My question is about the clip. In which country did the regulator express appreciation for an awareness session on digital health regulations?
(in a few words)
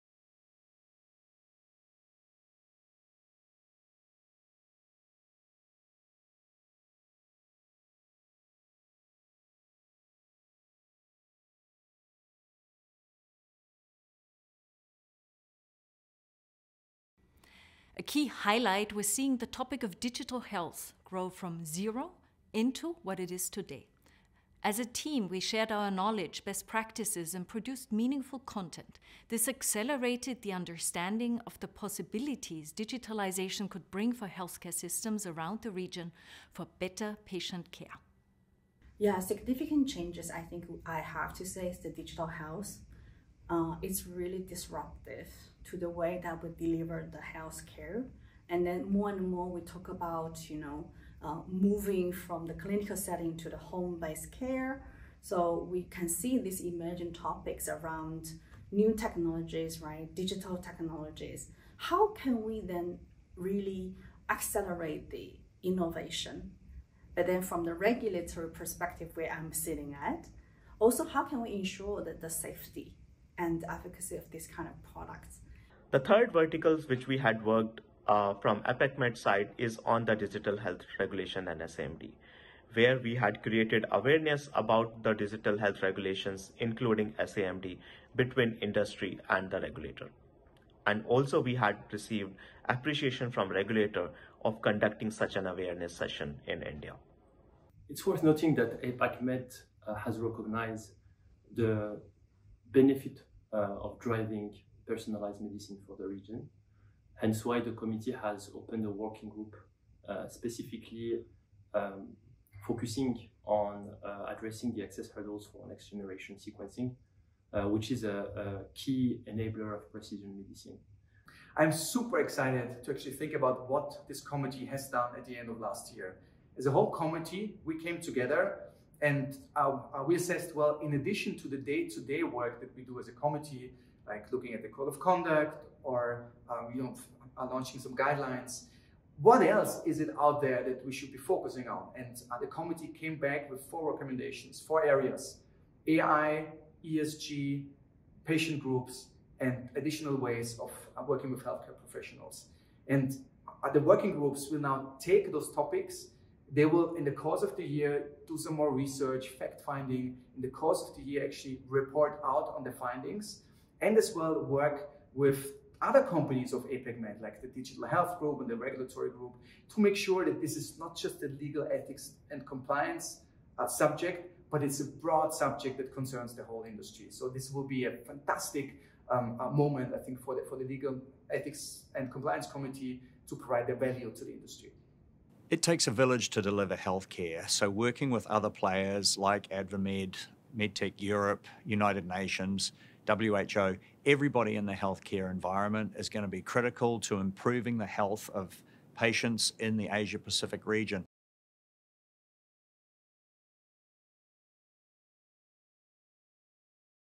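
India.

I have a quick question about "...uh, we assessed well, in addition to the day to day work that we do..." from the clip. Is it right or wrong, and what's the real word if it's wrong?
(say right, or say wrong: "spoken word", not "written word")
right.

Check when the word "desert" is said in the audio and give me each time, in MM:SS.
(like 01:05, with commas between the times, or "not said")
not said.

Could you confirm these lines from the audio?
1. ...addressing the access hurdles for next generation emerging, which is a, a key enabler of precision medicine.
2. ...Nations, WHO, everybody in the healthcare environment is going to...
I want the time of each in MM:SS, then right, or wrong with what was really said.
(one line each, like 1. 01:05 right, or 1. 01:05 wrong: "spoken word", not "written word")
1. 01:54 wrong: "sequencing", not "emerging"
2. 03:12 right.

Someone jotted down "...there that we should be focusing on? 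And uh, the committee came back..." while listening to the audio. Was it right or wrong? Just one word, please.
right.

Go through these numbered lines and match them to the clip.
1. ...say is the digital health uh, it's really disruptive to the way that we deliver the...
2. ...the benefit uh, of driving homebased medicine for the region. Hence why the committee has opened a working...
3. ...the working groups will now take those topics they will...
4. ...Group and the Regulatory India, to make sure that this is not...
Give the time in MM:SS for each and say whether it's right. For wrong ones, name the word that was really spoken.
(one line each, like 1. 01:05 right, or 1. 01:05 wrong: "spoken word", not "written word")
1. 00:41 right
2. 01:41 wrong: "personalized", not "homebased"
3. 02:33 right
4. 02:48 wrong: "Group", not "India".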